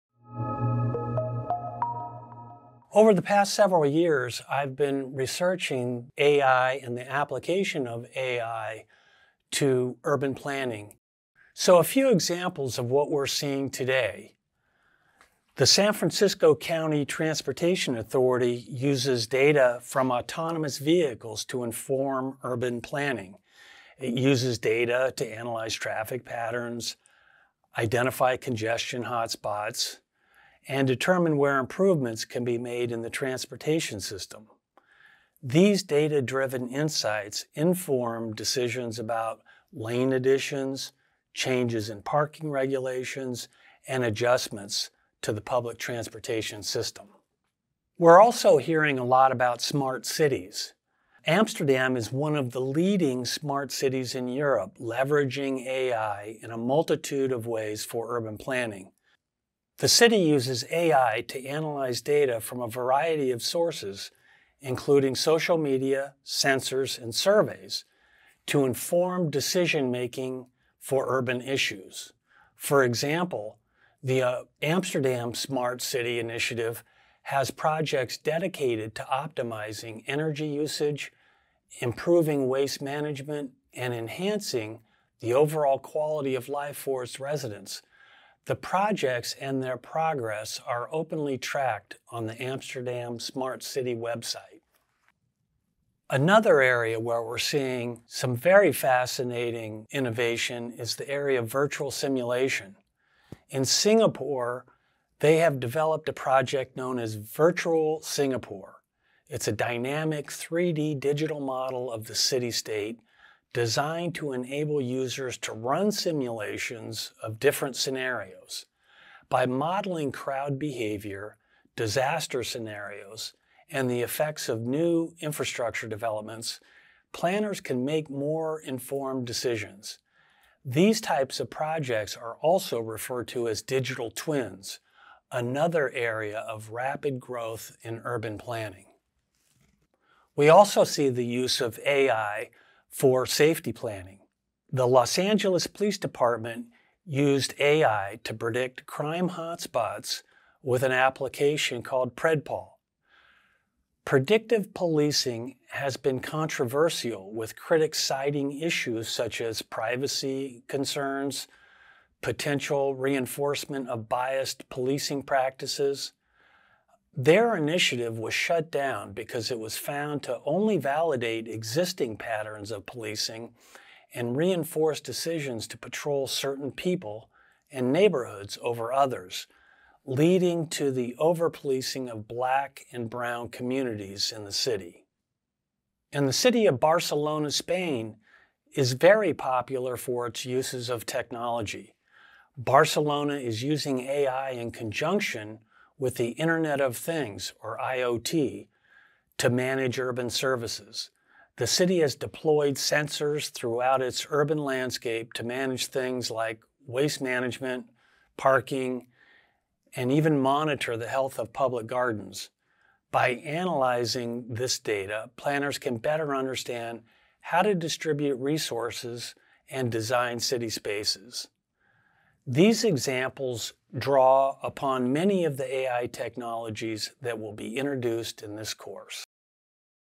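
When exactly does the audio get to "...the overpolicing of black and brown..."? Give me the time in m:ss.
3:00.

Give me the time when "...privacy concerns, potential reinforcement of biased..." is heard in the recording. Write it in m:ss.
2:39.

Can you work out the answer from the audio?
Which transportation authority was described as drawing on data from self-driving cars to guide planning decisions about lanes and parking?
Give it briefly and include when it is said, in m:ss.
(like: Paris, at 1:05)
San Francisco County Transportation Authority, at 0:15.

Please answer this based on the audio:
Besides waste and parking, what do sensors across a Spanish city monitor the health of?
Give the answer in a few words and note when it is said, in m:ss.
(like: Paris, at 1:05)
public gardens, at 3:31.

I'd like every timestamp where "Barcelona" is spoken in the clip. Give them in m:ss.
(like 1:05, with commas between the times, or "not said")
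3:06, 3:12.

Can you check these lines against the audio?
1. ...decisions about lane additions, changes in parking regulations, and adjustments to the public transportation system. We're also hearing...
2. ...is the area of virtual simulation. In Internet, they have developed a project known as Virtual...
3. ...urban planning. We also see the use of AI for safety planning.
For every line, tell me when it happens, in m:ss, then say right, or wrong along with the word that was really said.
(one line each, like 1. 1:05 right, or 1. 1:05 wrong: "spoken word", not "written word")
1. 0:38 right
2. 1:40 wrong: "Singapore", not "Internet"
3. 2:18 right.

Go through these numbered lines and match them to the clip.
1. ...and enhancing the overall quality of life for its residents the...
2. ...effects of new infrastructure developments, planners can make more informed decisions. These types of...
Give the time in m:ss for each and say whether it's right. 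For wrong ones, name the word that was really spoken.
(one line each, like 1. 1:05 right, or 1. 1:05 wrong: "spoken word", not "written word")
1. 1:23 right
2. 2:04 right.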